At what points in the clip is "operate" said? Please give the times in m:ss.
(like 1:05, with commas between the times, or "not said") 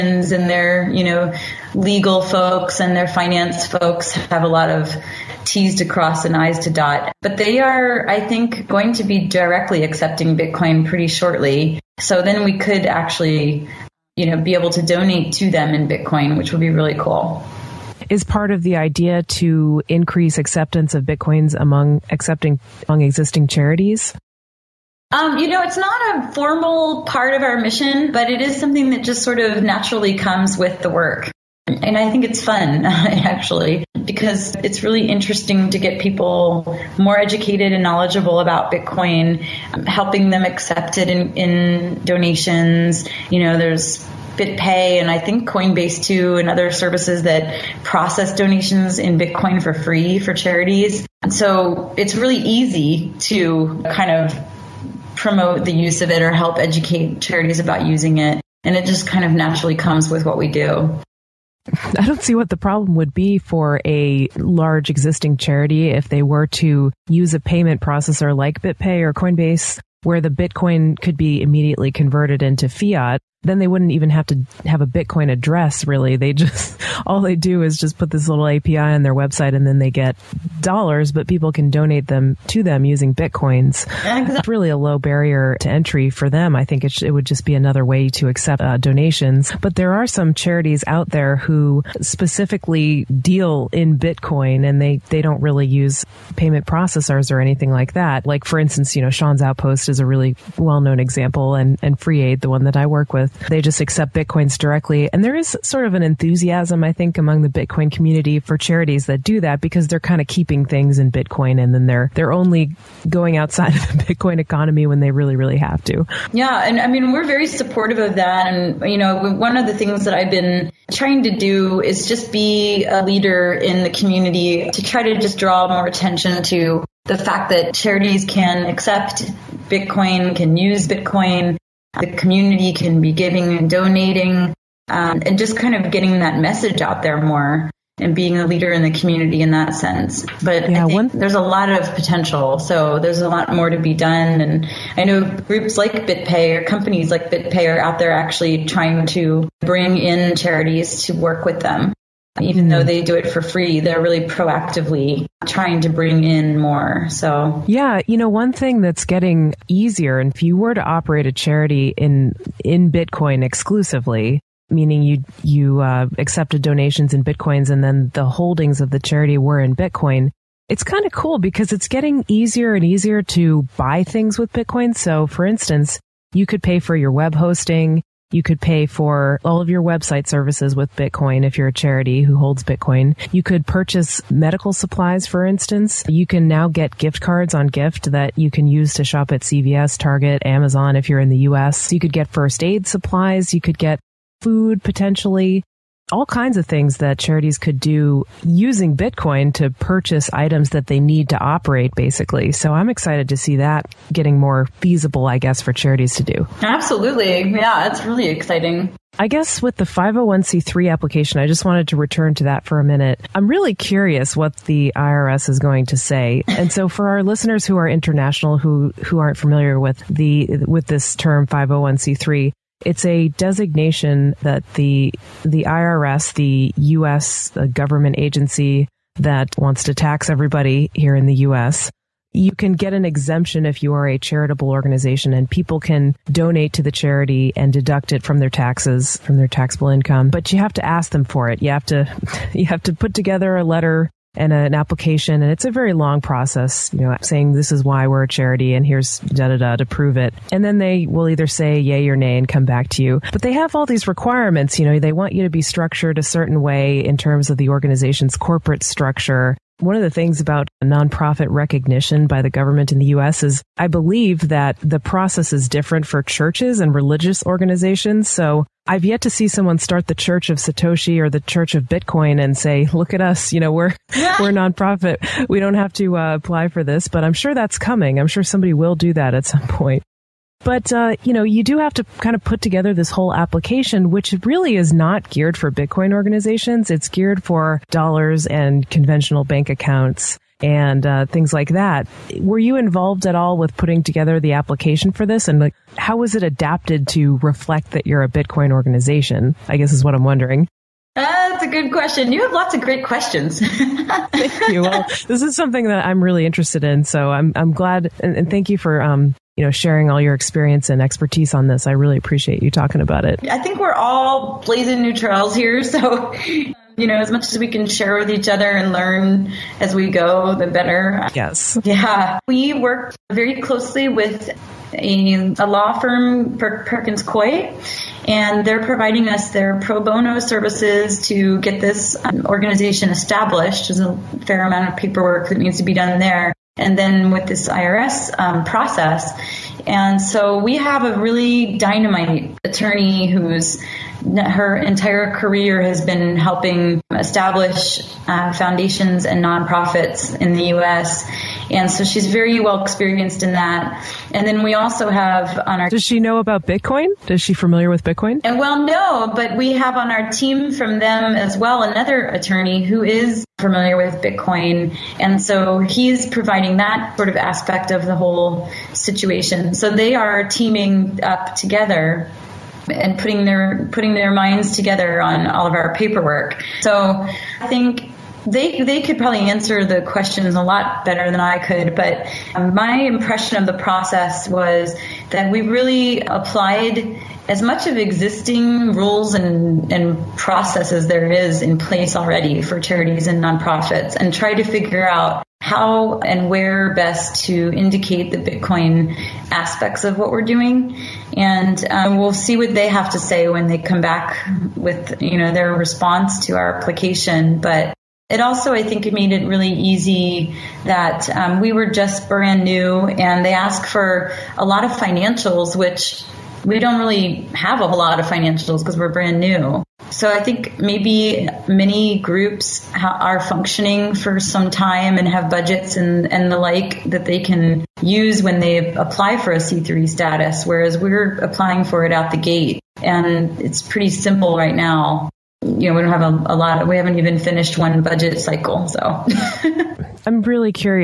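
2:40, 3:21.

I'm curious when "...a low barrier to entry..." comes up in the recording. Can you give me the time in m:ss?
1:24.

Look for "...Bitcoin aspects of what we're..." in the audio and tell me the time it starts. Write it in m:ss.
6:38.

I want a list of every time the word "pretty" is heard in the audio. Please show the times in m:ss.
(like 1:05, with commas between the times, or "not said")
0:10, 7:13.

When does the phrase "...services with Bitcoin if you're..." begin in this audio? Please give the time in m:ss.
3:00.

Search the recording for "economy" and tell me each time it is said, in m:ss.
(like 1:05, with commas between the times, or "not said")
1:54.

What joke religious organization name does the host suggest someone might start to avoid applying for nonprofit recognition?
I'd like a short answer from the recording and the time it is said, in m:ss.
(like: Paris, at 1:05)
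Church of Satoshi, at 4:30.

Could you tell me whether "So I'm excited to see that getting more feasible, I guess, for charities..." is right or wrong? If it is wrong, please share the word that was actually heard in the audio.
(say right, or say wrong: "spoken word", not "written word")
right.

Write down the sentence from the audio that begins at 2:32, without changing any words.
they do it for free, they're really proactively trying to bring in more.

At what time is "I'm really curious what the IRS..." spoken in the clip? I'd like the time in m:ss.
3:33.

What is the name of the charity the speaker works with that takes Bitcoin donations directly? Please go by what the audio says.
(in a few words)
Free Aid.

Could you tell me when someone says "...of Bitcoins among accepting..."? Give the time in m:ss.
0:20.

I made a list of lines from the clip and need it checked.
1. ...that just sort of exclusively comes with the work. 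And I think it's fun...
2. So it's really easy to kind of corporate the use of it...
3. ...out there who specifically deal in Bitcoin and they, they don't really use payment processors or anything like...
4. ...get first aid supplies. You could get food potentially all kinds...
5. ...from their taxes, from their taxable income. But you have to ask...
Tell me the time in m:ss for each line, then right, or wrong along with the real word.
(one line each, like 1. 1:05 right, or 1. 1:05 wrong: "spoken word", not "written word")
1. 0:28 wrong: "naturally", not "exclusively"
2. 0:51 wrong: "promote", not "corporate"
3. 1:30 right
4. 3:12 right
5. 3:58 right.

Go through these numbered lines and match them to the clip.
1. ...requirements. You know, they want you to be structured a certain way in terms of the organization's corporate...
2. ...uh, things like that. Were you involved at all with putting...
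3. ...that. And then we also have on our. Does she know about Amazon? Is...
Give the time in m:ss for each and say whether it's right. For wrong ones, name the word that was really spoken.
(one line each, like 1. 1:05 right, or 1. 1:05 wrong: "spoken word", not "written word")
1. 4:14 right
2. 4:51 right
3. 5:53 wrong: "Bitcoin", not "Amazon".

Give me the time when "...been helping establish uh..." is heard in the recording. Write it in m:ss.
5:46.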